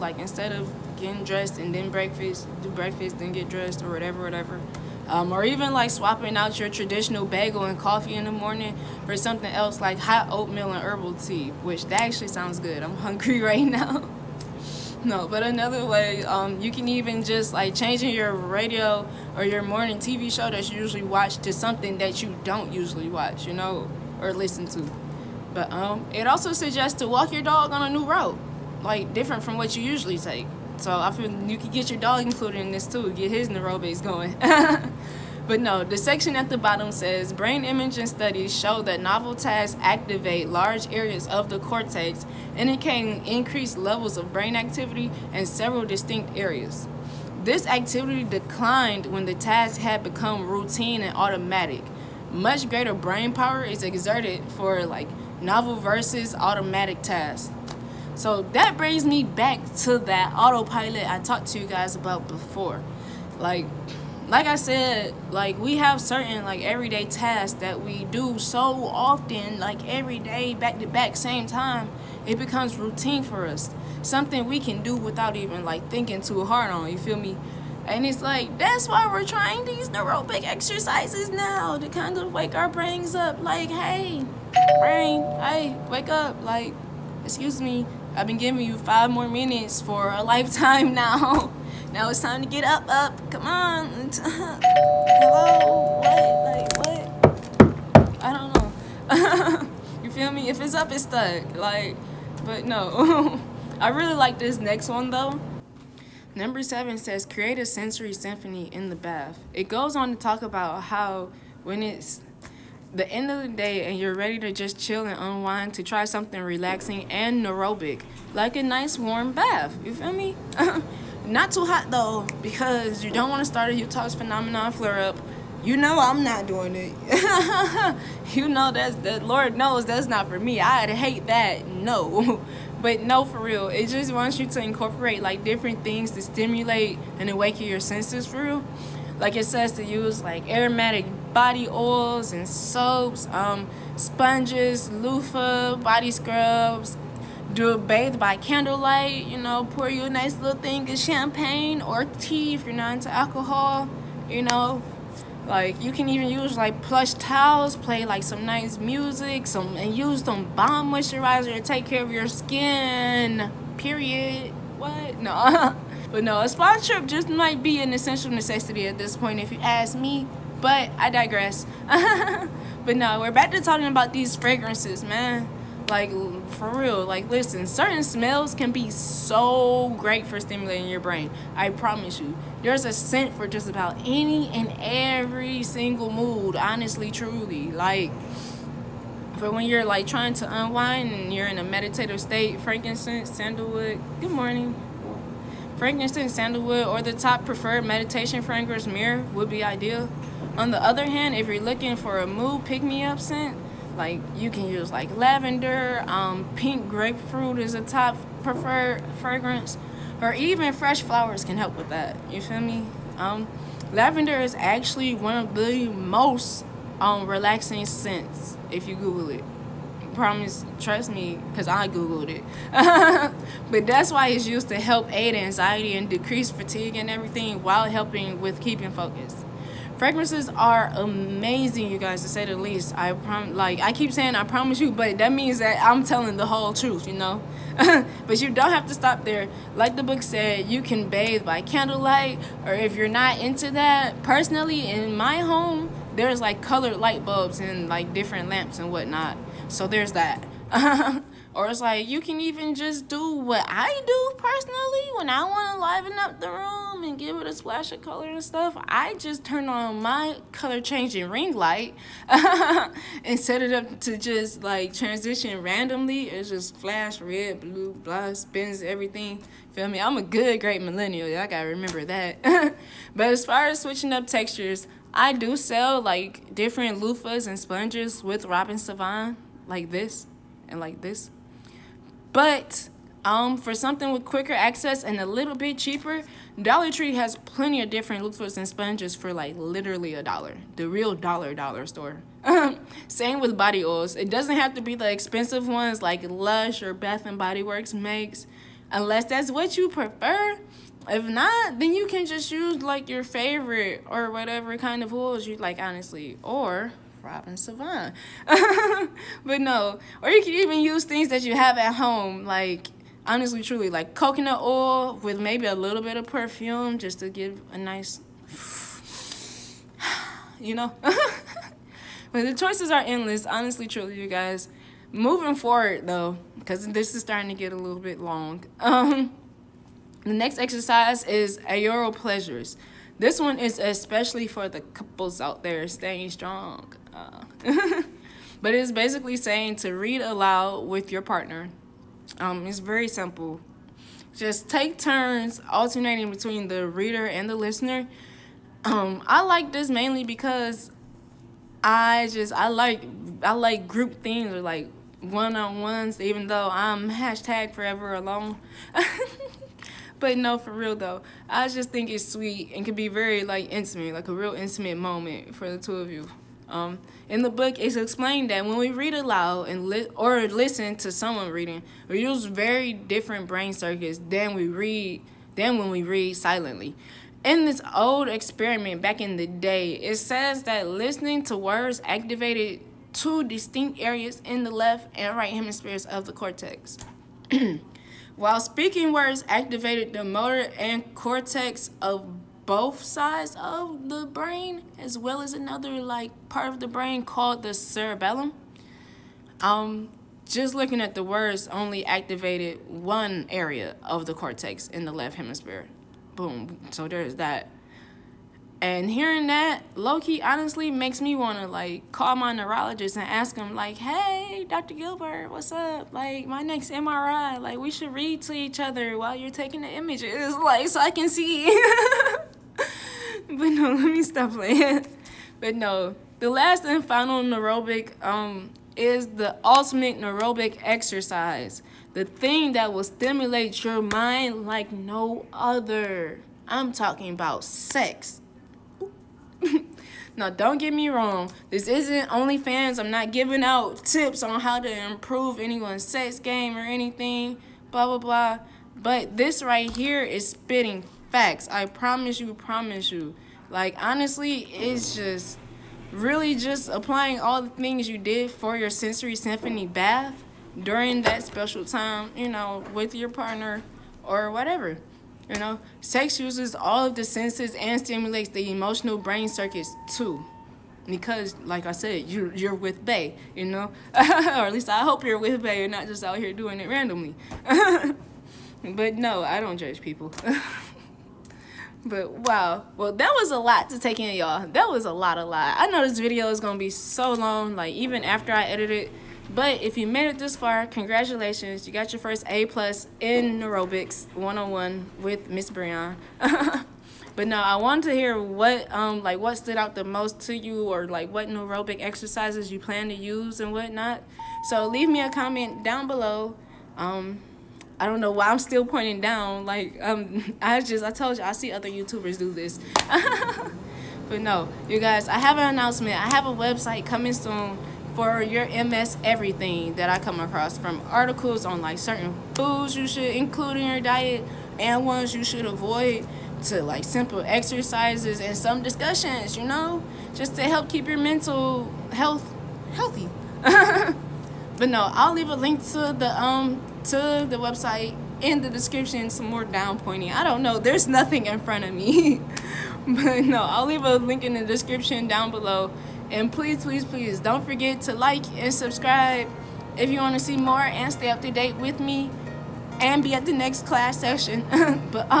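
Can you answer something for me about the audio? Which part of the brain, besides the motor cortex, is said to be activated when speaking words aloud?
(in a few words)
cerebellum.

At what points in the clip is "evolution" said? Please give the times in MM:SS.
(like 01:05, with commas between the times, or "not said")
not said.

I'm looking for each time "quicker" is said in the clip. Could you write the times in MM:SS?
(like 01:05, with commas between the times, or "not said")
04:44.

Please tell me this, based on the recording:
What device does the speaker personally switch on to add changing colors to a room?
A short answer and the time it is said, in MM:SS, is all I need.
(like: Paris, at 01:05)
color changing ring light, at 04:20.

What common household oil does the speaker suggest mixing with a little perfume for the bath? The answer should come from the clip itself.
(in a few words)
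coconut oil.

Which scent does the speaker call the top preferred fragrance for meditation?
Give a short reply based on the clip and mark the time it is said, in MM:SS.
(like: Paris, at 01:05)
myrrh, at 03:18.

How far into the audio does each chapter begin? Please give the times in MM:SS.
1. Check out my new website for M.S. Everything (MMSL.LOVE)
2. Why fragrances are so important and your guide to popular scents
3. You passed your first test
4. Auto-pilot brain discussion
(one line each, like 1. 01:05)
1. 08:35
2. 02:55
3. 08:03
4. 00:58.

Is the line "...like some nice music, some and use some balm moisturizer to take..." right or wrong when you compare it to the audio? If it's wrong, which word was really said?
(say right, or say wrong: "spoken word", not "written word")
right.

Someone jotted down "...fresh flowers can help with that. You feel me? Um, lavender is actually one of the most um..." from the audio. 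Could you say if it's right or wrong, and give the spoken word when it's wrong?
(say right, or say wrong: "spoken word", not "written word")
right.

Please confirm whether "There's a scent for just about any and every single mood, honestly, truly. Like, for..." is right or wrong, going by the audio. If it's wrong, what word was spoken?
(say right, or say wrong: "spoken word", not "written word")
right.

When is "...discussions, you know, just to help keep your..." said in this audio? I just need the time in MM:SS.
08:48.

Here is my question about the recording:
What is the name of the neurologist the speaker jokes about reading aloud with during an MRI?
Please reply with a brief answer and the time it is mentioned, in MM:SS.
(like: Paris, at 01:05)
Dr. Gilbert, at 06:54.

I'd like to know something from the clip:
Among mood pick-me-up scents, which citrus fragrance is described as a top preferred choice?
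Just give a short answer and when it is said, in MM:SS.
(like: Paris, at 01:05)
pink grapefruit, at 03:26.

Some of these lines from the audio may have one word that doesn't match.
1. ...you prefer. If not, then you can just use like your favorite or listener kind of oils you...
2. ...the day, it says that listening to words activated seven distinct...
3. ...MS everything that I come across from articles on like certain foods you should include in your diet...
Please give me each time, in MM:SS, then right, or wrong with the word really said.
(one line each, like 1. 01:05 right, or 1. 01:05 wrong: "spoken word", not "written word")
1. 04:59 wrong: "whatever", not "listener"
2. 06:19 wrong: "two", not "seven"
3. 08:38 right.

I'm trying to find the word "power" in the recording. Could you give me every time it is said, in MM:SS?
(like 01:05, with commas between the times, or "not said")
00:53.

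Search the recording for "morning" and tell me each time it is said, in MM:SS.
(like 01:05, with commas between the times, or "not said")
00:08, 00:19, 03:14.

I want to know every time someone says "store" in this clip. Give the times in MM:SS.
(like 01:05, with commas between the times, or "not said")
04:51.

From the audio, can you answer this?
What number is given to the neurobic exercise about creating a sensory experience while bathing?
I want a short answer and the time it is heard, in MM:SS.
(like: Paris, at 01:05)
7, at 01:46.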